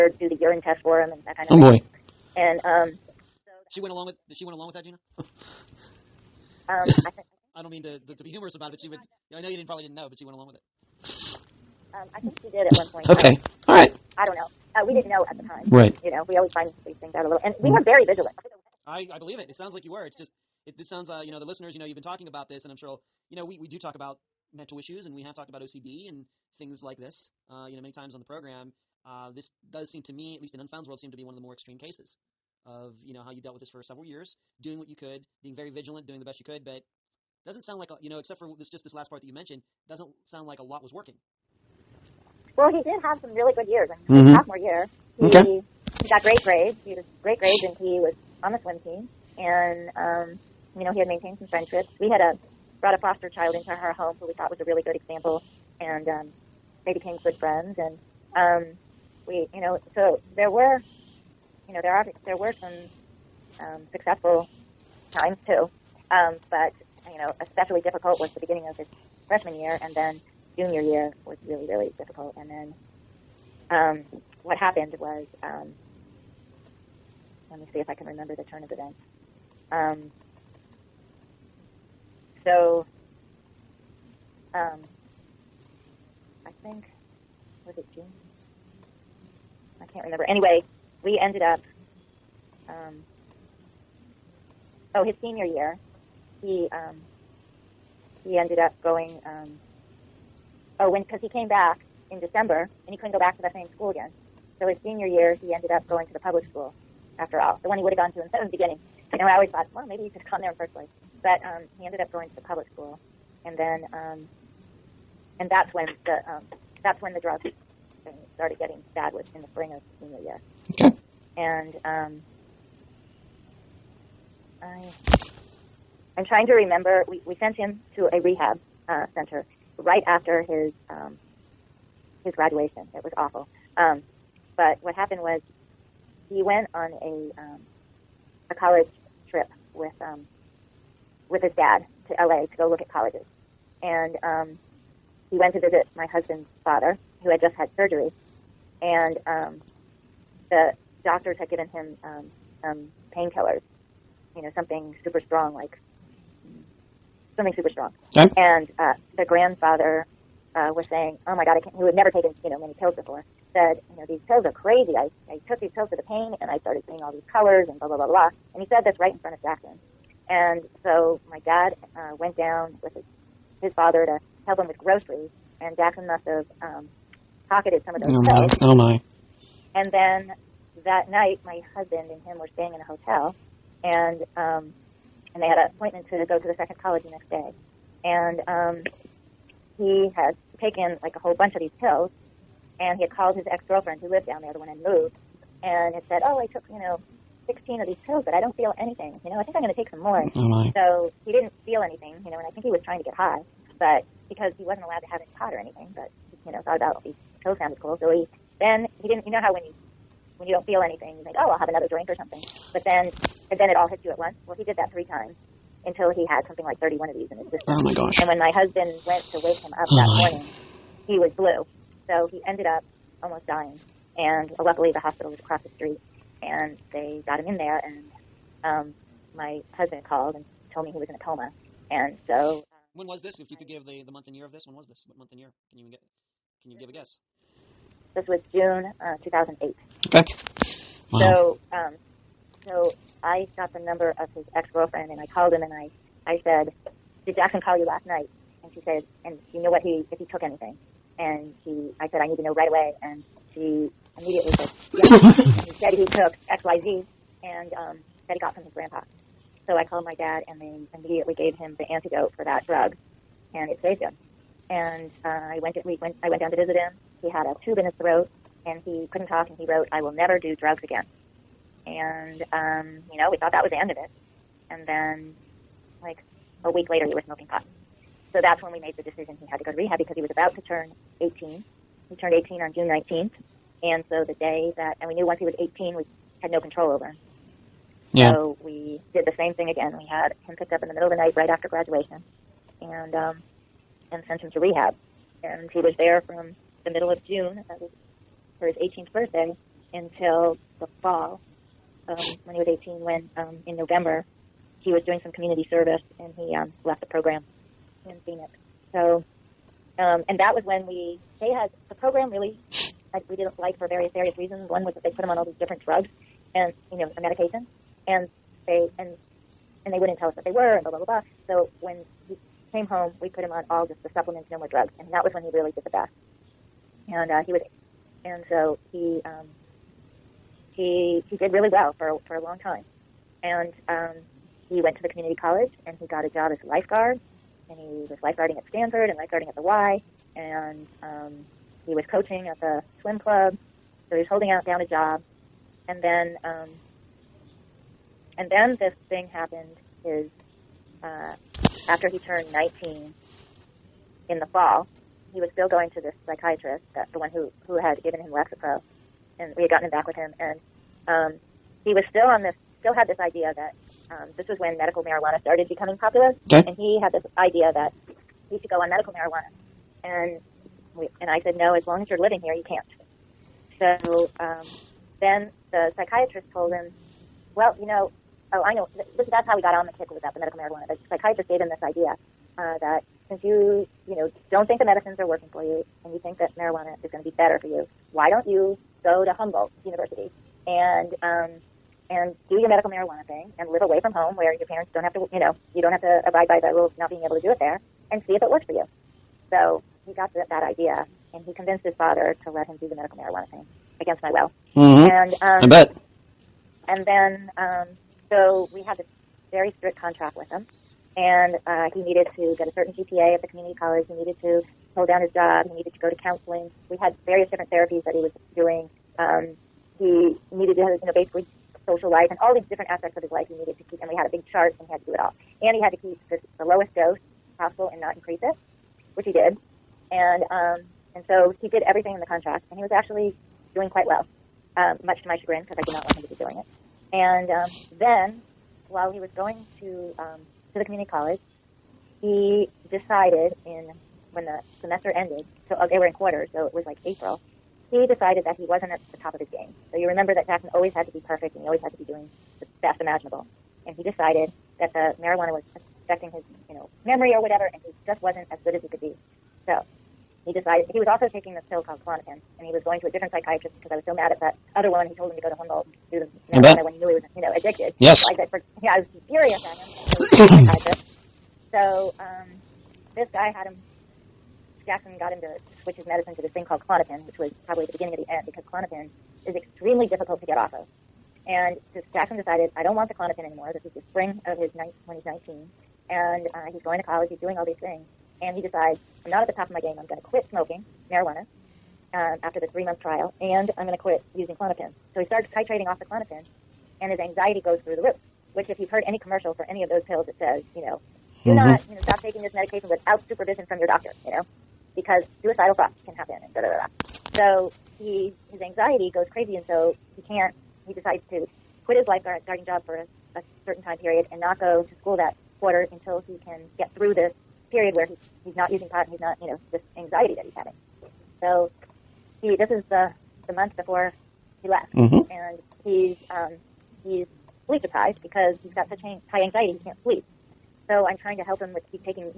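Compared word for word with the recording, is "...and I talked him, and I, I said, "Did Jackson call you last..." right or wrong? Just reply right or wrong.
wrong.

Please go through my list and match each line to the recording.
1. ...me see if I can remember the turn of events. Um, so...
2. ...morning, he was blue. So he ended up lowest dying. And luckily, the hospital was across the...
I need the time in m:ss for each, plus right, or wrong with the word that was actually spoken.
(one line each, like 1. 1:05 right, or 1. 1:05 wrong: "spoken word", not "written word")
1. 1:17 right
2. 3:40 wrong: "almost", not "lowest".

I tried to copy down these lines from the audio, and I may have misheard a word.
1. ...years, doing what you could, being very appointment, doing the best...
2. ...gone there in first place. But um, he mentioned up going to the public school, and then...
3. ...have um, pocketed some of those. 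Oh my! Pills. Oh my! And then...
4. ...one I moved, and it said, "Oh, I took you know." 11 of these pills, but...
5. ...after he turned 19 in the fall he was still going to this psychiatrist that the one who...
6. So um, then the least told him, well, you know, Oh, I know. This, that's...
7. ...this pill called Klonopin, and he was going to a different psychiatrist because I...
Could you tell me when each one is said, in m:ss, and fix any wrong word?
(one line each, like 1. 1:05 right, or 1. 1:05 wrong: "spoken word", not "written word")
1. 0:34 wrong: "vigilant", not "appointment"
2. 1:50 wrong: "ended", not "mentioned"
3. 2:56 right
4. 3:14 wrong: "16", not "11"
5. 5:51 right
6. 6:13 wrong: "psychiatrist", not "least"
7. 7:41 right.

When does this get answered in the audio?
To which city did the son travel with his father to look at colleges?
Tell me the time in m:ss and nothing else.
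2:22.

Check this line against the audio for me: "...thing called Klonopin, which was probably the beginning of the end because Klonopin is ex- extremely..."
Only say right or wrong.
right.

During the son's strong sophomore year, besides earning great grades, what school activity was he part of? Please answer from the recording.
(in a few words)
Swim team.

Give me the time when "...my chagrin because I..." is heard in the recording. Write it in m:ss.
7:15.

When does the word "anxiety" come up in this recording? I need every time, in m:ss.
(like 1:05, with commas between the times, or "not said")
8:17, 8:28, 8:39, 8:49.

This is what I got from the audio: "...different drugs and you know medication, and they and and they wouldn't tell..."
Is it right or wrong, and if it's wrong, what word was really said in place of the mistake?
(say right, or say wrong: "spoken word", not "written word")
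right.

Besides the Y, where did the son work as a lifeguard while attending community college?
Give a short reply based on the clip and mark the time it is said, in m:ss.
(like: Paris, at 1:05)
Stanford, at 5:38.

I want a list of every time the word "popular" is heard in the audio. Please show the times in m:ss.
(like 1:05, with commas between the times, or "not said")
6:05.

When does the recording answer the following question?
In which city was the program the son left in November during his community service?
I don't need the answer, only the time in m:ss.
5:08.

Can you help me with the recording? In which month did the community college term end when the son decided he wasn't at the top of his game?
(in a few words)
April.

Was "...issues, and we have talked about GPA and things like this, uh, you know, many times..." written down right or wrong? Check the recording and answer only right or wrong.
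wrong.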